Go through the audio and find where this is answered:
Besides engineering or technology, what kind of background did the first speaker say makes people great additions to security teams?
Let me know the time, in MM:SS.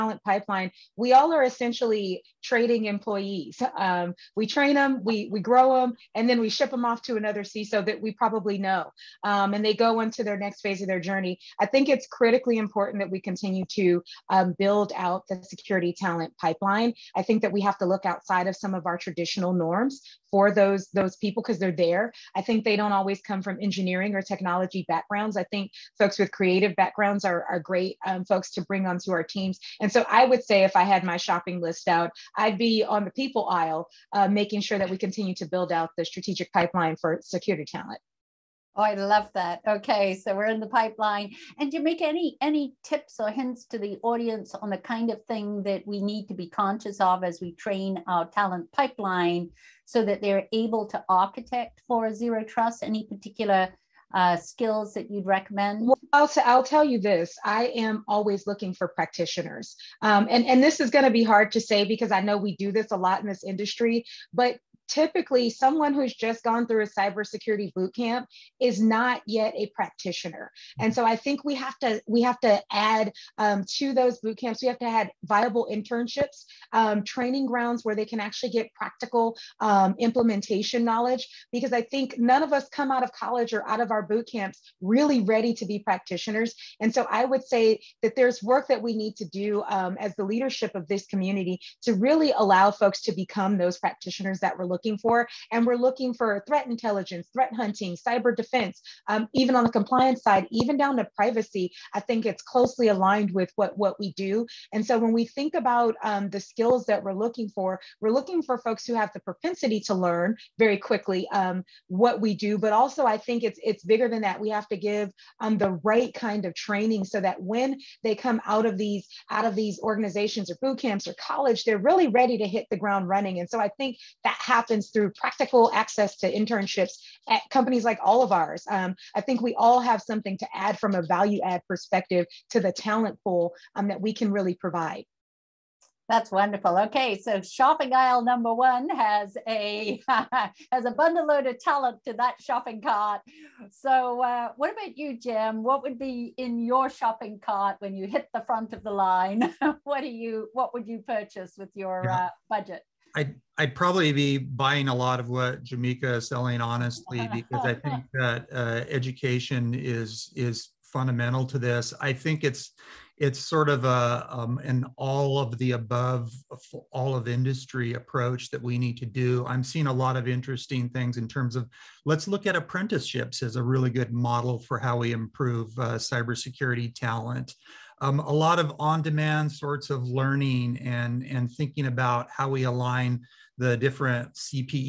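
00:26.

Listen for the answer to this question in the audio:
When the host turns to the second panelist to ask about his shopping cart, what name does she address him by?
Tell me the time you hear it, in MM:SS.
02:25.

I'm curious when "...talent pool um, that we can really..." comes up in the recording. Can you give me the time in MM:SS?
02:12.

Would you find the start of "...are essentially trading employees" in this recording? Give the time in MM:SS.
00:01.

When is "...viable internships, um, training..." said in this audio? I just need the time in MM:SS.
01:15.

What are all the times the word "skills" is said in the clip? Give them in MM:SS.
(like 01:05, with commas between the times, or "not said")
00:54, 01:46.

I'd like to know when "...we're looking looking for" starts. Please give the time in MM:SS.
01:34.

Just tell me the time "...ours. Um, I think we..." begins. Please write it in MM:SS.
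02:08.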